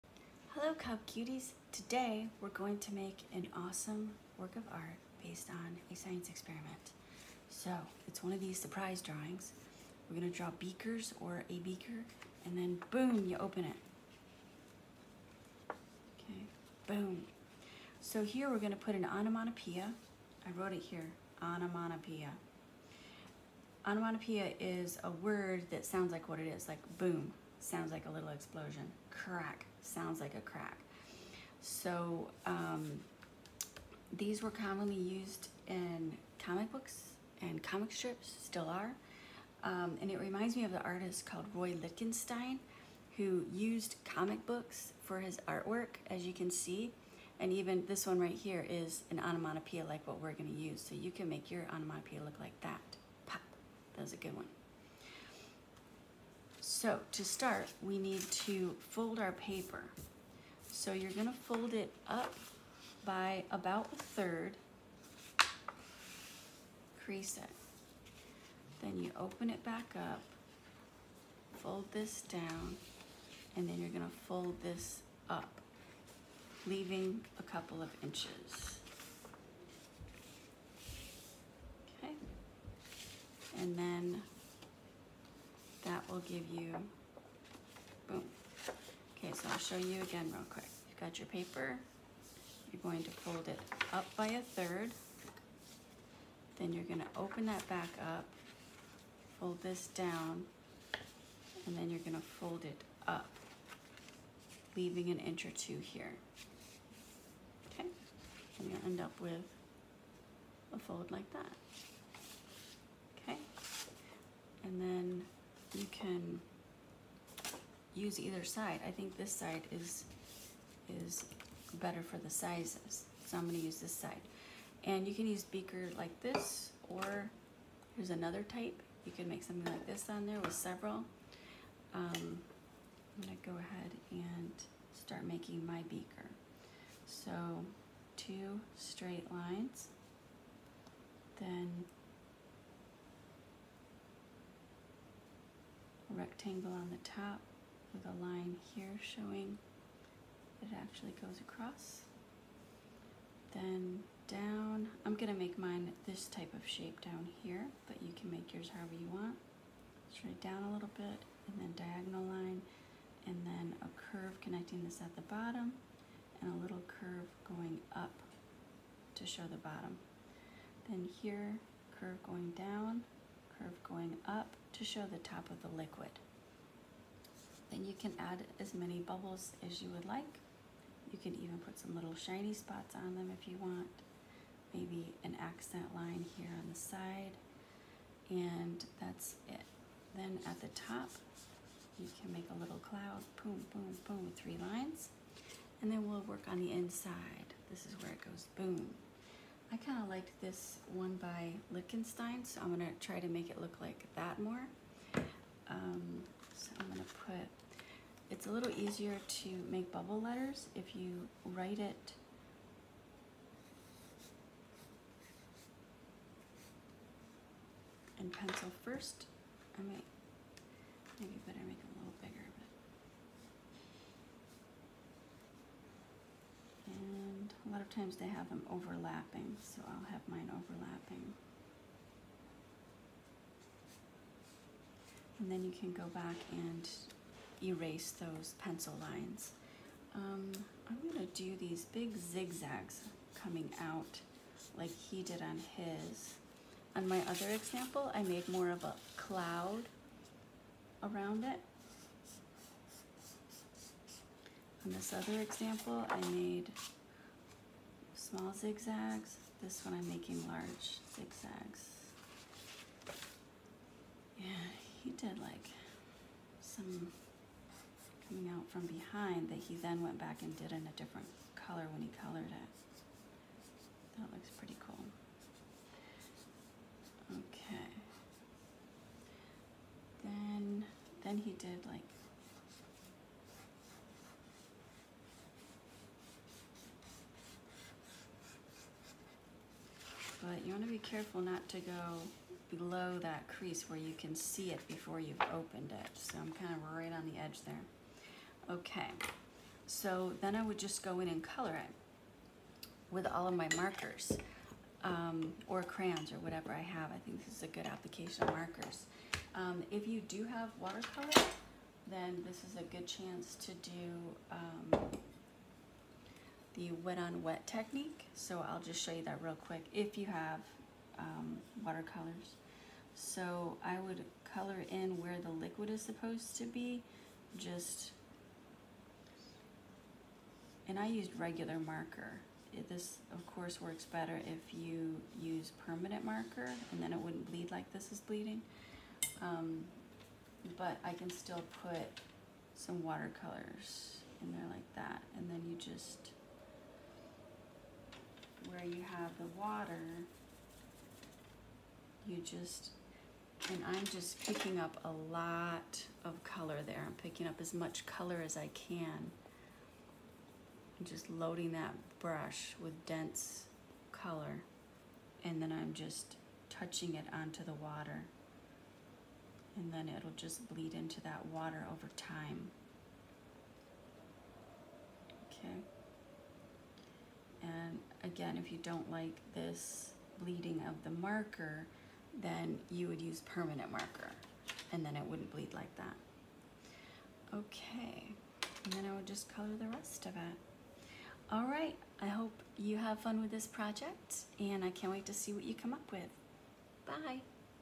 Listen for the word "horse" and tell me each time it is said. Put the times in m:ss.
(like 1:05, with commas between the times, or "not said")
not said.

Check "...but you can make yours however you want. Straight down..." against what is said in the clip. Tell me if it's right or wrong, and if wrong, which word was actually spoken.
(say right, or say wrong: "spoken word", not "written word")
right.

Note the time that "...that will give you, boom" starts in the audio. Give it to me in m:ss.
1:25.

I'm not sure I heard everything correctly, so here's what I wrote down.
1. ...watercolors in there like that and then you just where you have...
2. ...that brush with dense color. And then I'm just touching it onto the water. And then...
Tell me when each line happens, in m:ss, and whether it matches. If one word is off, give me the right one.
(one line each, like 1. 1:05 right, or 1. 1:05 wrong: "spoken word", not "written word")
1. 5:43 right
2. 6:01 right.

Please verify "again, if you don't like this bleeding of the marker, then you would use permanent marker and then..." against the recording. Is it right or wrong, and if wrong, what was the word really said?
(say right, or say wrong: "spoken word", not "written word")
right.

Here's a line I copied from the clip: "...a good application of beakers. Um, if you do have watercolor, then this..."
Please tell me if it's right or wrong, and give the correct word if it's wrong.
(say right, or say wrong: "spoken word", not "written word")
wrong: "markers", not "beakers".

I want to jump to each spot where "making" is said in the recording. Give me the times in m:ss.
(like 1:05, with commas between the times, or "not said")
2:15, 4:20.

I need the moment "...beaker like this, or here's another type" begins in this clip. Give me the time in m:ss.
2:05.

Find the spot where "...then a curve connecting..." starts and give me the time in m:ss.
2:43.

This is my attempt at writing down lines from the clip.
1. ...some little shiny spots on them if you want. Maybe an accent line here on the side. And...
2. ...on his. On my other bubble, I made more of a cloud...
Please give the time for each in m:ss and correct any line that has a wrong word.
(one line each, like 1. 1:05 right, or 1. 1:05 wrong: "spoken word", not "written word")
1. 3:01 right
2. 4:05 wrong: "example", not "bubble".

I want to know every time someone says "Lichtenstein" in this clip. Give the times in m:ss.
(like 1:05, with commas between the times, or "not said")
0:41, 3:21.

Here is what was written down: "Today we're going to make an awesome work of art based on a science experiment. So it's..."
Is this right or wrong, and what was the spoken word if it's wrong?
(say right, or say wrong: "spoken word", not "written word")
right.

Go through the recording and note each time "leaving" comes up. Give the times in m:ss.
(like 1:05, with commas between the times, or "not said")
1:16, 1:44.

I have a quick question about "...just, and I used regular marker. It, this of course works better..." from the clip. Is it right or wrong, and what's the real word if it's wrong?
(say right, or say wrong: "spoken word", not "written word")
right.